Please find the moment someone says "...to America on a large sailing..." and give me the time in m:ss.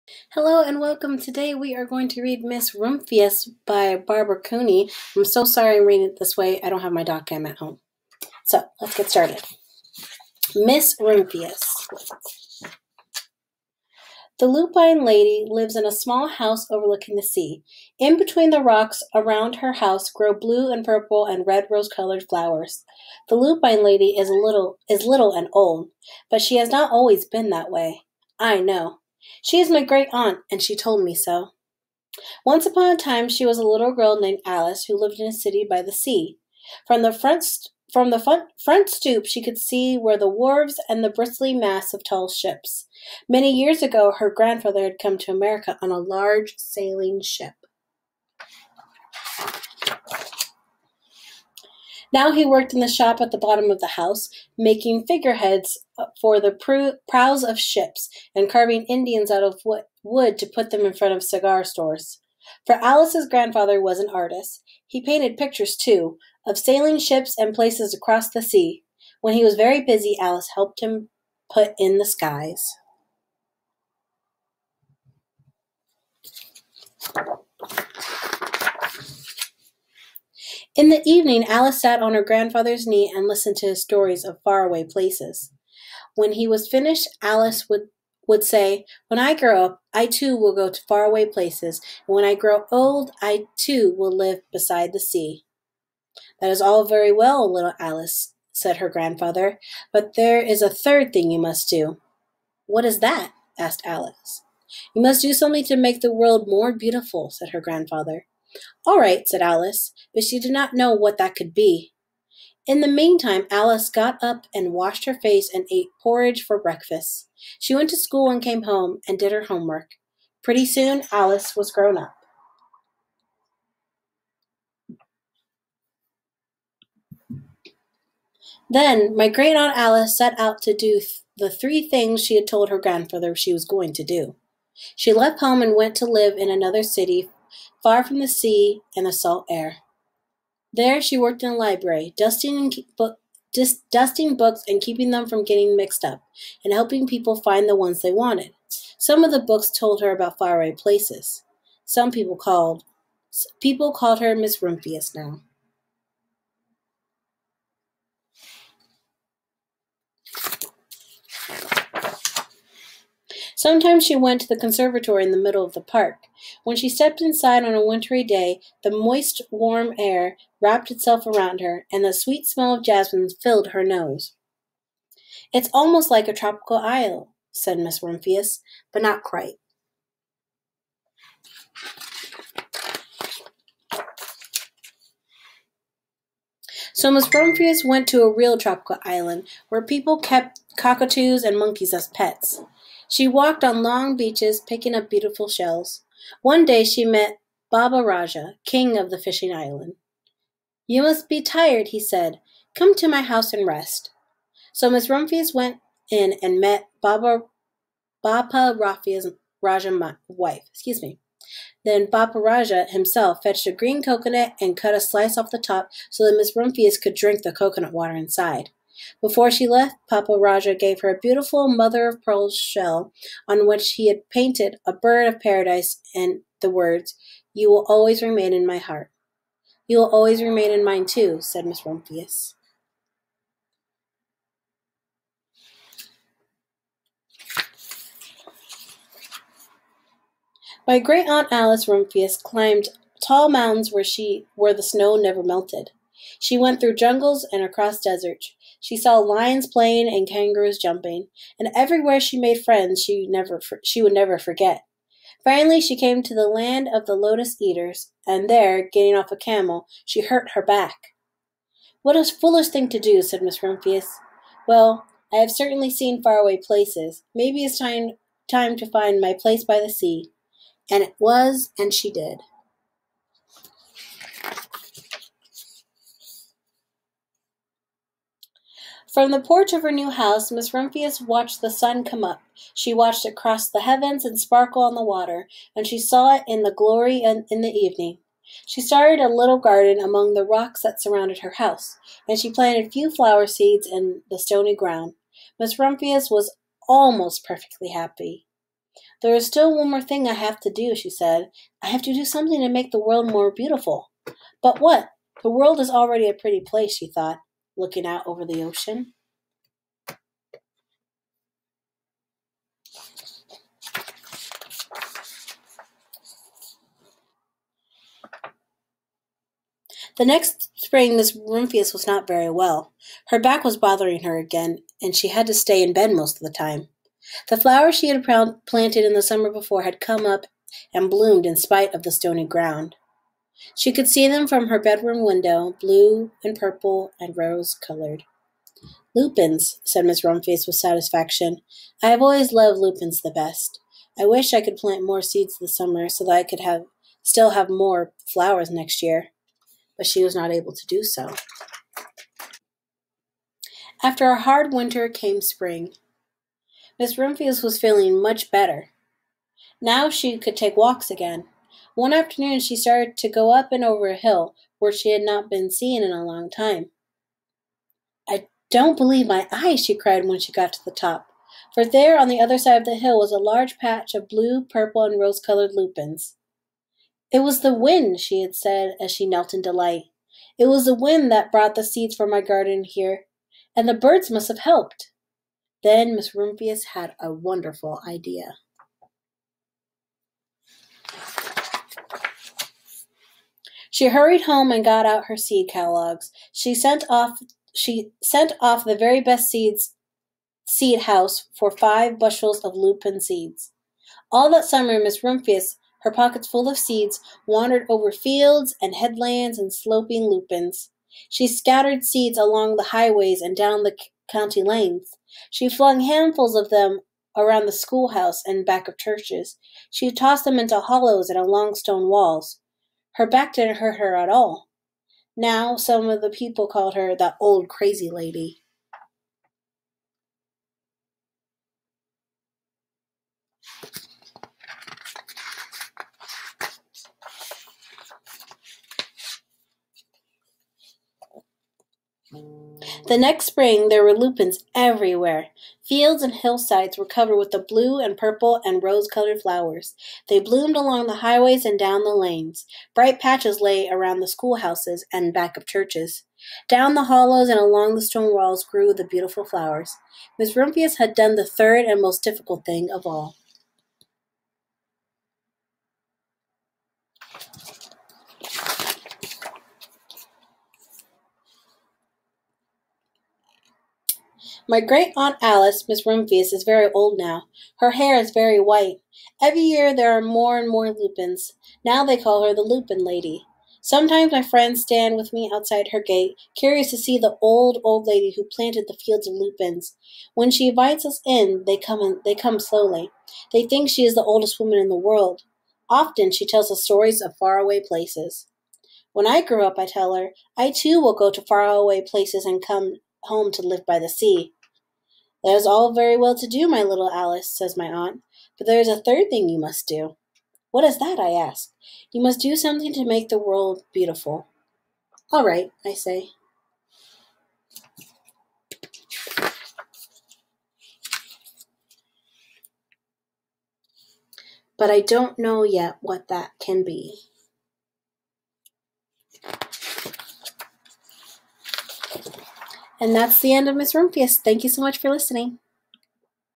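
0:45.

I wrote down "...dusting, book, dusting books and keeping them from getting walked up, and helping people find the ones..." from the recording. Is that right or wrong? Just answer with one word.
wrong.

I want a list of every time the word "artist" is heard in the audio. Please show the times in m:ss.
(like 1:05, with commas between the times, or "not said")
1:04.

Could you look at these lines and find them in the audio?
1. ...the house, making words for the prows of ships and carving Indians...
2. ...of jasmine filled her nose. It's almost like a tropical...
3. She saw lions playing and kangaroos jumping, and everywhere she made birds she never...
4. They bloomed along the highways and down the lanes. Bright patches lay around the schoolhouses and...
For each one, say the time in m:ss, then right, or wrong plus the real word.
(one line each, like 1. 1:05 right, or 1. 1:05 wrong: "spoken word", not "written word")
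1. 0:53 wrong: "figureheads", not "words"
2. 2:52 right
3. 4:08 wrong: "friends", not "birds"
4. 7:30 right.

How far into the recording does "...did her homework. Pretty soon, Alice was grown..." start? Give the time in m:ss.
1:59.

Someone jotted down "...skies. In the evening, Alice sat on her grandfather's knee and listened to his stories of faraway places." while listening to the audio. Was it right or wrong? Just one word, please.
right.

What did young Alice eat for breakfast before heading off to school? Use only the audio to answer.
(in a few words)
porridge.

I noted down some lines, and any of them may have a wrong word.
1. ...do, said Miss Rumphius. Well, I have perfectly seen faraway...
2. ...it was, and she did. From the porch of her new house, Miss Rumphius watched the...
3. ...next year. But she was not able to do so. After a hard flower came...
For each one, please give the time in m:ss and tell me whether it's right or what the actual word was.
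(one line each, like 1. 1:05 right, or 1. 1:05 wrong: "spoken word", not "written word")
1. 4:22 wrong: "certainly", not "perfectly"
2. 4:31 right
3. 5:48 wrong: "winter", not "flower".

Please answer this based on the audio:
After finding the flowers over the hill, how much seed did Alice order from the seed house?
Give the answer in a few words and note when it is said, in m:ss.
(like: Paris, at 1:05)
5 bushels, at 6:41.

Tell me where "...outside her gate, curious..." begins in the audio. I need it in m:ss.
8:05.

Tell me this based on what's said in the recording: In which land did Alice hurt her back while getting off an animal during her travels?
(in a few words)
land of the lotus eaters.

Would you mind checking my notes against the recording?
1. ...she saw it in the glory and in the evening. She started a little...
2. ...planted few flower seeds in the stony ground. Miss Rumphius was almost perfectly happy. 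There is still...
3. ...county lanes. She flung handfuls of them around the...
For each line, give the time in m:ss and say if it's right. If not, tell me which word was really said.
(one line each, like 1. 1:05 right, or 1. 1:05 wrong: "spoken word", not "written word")
1. 4:45 right
2. 4:52 right
3. 6:54 right.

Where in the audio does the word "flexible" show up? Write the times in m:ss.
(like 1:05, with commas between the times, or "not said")
not said.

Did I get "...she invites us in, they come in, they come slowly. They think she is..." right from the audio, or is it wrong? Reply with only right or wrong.
right.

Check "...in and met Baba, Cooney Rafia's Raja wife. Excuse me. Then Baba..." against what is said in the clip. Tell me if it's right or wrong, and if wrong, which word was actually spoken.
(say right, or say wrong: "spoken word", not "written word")
wrong: "Bapa", not "Cooney".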